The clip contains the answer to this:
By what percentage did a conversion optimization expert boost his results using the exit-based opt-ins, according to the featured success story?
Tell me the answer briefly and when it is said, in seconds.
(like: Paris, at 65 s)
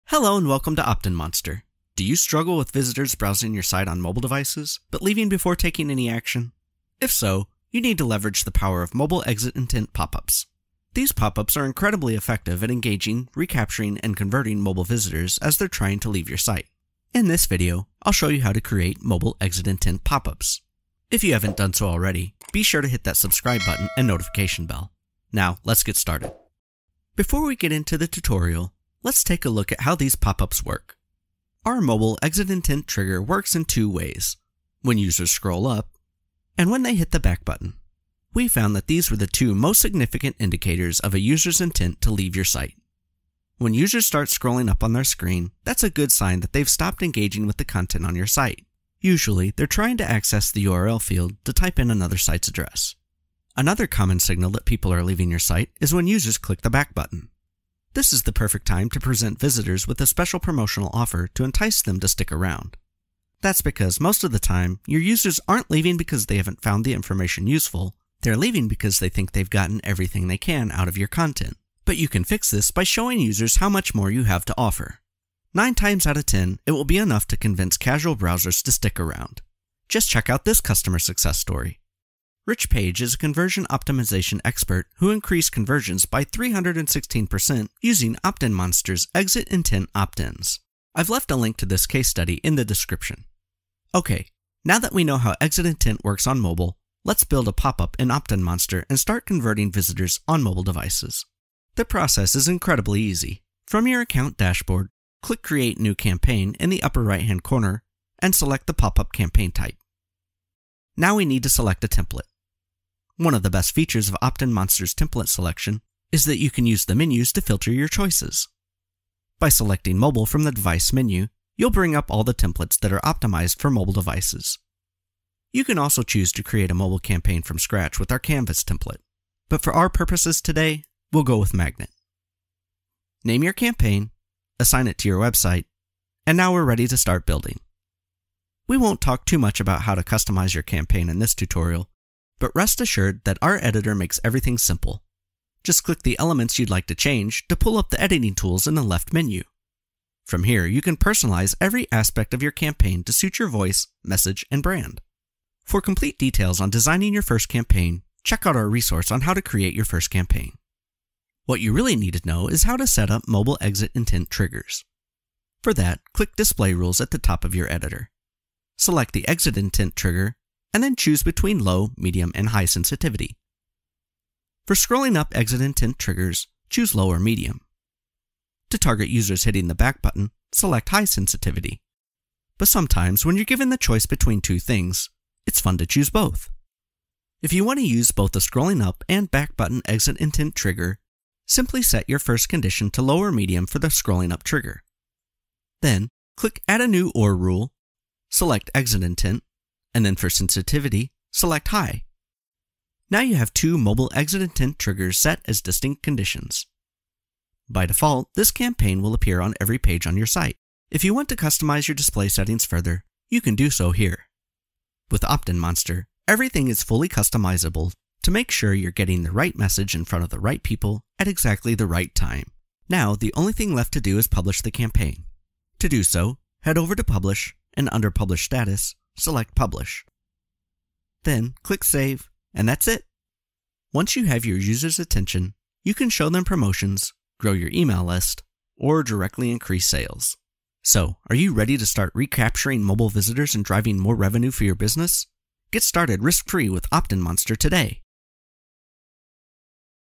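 316%, at 86 s.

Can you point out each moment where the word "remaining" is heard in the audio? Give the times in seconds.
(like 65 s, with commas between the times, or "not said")
not said.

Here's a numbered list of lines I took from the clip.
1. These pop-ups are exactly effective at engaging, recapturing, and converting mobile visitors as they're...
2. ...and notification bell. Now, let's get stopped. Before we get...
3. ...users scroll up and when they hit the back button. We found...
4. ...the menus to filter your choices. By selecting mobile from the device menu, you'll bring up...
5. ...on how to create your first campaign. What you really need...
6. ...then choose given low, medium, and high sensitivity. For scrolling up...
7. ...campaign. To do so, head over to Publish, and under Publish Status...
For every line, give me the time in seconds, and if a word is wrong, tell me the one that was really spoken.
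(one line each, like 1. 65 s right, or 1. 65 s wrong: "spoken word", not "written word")
1. 10 s wrong: "incredibly", not "exactly"
2. 23 s wrong: "started", not "stopped"
3. 34 s right
4. 116 s right
5. 159 s right
6. 170 s wrong: "between", not "given"
7. 224 s right.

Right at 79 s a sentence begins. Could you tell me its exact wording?
Just check out this customer success story.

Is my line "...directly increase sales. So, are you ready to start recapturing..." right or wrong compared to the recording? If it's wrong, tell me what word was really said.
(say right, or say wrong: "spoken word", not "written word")
right.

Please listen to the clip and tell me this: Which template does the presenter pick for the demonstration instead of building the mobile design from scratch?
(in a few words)
Magnet.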